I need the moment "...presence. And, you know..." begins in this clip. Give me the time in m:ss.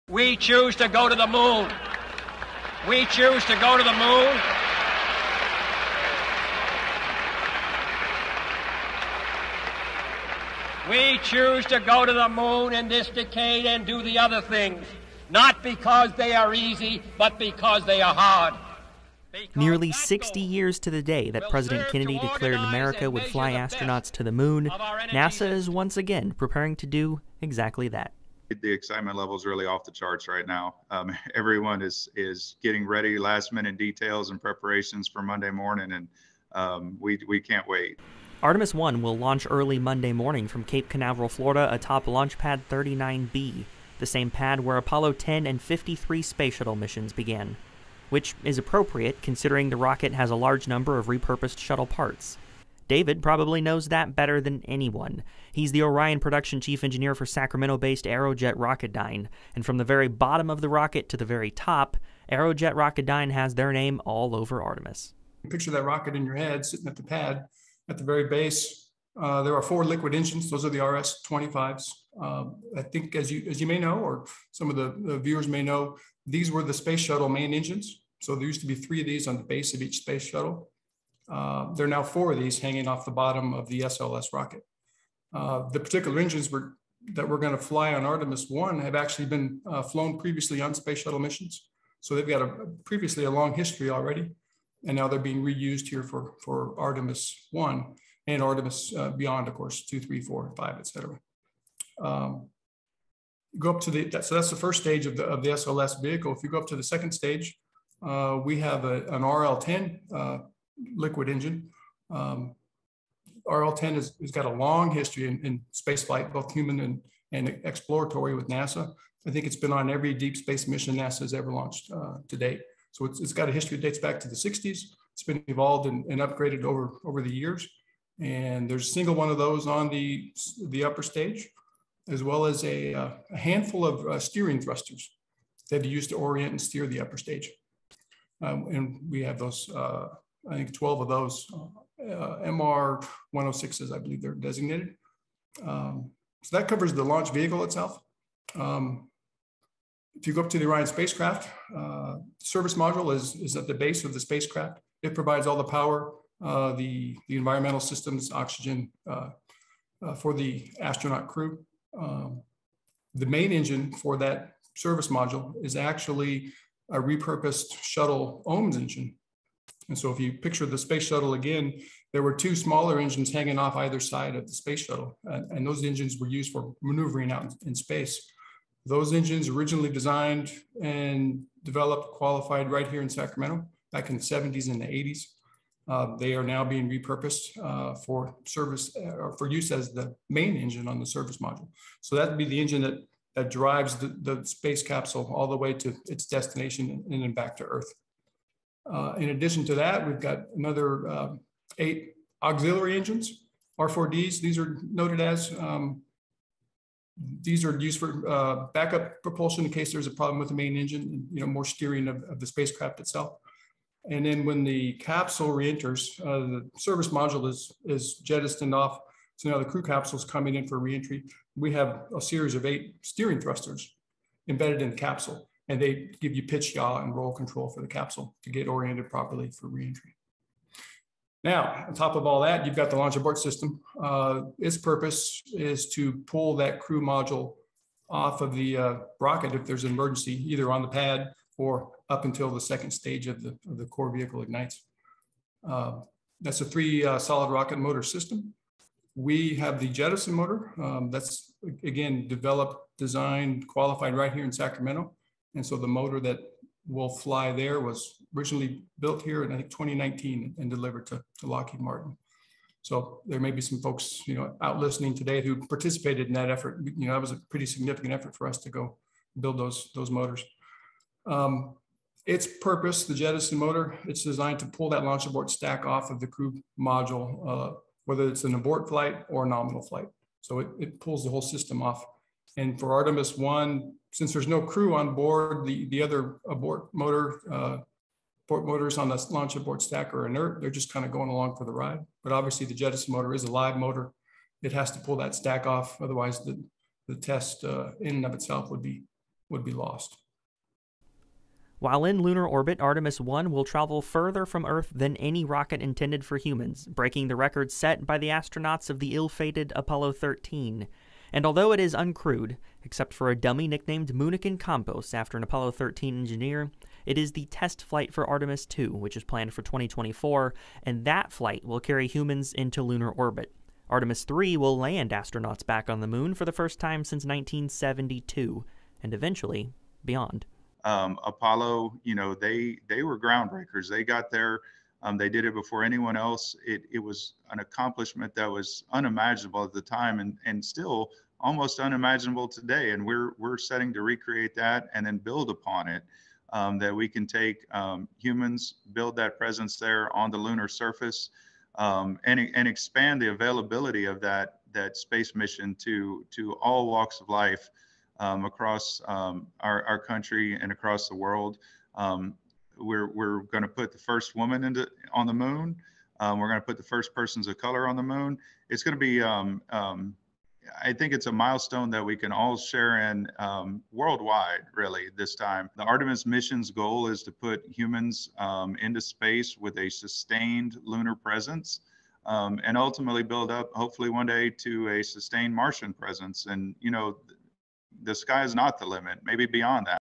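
6:25.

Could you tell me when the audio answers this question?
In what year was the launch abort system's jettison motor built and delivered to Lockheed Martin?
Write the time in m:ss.
4:19.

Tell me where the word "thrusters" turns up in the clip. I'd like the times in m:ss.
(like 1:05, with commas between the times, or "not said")
2:14, 3:43.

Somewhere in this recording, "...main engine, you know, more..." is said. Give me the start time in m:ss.
3:30.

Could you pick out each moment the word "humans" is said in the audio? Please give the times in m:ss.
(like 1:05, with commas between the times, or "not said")
1:56, 5:06, 5:22, 5:48, 6:17.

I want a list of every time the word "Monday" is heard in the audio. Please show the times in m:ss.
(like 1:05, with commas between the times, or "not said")
0:35, 0:39.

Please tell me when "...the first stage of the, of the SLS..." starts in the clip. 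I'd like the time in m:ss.
1:44.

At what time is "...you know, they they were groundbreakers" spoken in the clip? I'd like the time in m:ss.
5:32.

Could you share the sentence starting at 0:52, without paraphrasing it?
David probably knows that better than anyone.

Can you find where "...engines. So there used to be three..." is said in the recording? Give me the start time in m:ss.
1:17.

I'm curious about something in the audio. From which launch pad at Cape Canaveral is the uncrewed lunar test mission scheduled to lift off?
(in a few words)
Launch Pad 39B.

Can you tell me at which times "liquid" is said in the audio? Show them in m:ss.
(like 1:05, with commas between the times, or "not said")
1:09, 1:50.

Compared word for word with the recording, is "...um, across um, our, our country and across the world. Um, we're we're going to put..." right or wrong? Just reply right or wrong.
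right.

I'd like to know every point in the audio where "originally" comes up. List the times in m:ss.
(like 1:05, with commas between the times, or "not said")
2:59, 4:18.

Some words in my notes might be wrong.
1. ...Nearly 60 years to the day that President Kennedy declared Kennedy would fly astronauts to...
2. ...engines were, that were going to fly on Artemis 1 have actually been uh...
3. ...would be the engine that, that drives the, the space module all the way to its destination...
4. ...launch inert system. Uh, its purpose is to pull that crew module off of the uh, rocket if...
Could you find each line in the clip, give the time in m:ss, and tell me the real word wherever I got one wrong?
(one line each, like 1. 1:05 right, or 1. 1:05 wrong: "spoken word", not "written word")
1. 0:19 wrong: "America", not "Kennedy"
2. 1:26 right
3. 3:12 wrong: "capsule", not "module"
4. 3:52 wrong: "abort", not "inert".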